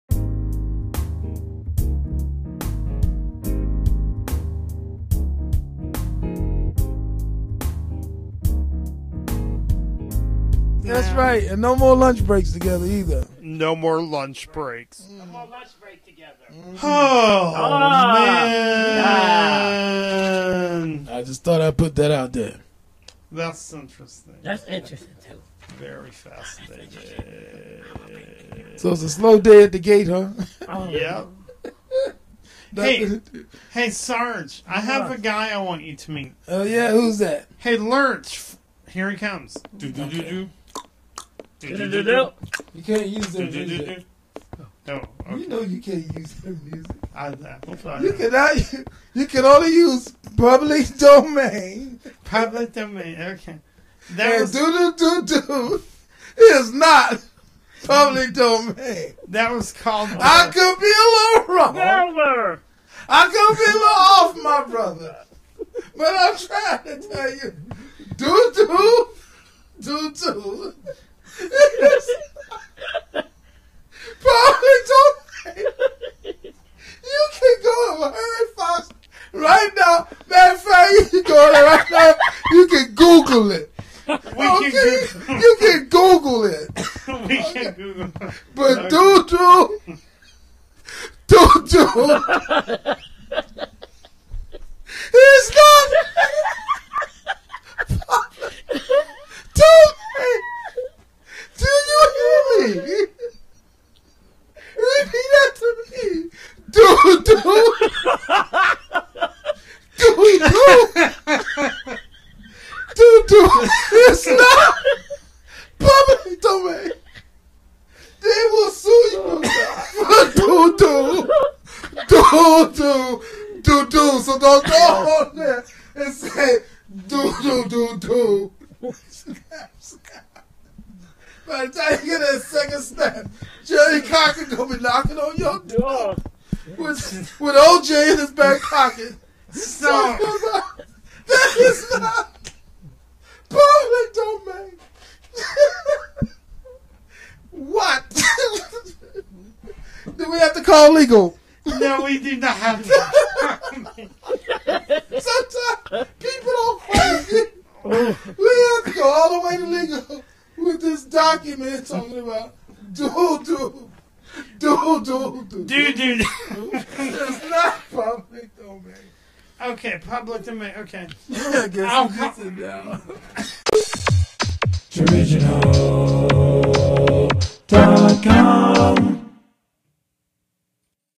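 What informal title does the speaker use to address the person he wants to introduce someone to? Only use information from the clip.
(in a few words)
Sarge.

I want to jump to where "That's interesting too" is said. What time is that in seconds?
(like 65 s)
24 s.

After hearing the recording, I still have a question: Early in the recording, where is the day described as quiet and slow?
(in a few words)
the gate.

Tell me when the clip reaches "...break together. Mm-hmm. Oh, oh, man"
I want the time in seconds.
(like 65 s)
15 s.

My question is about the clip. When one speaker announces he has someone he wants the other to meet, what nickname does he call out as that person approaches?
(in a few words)
Lurch.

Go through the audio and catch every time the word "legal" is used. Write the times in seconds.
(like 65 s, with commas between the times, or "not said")
150 s, 159 s.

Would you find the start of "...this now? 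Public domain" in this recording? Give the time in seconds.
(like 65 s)
113 s.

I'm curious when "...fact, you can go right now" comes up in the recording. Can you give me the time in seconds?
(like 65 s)
80 s.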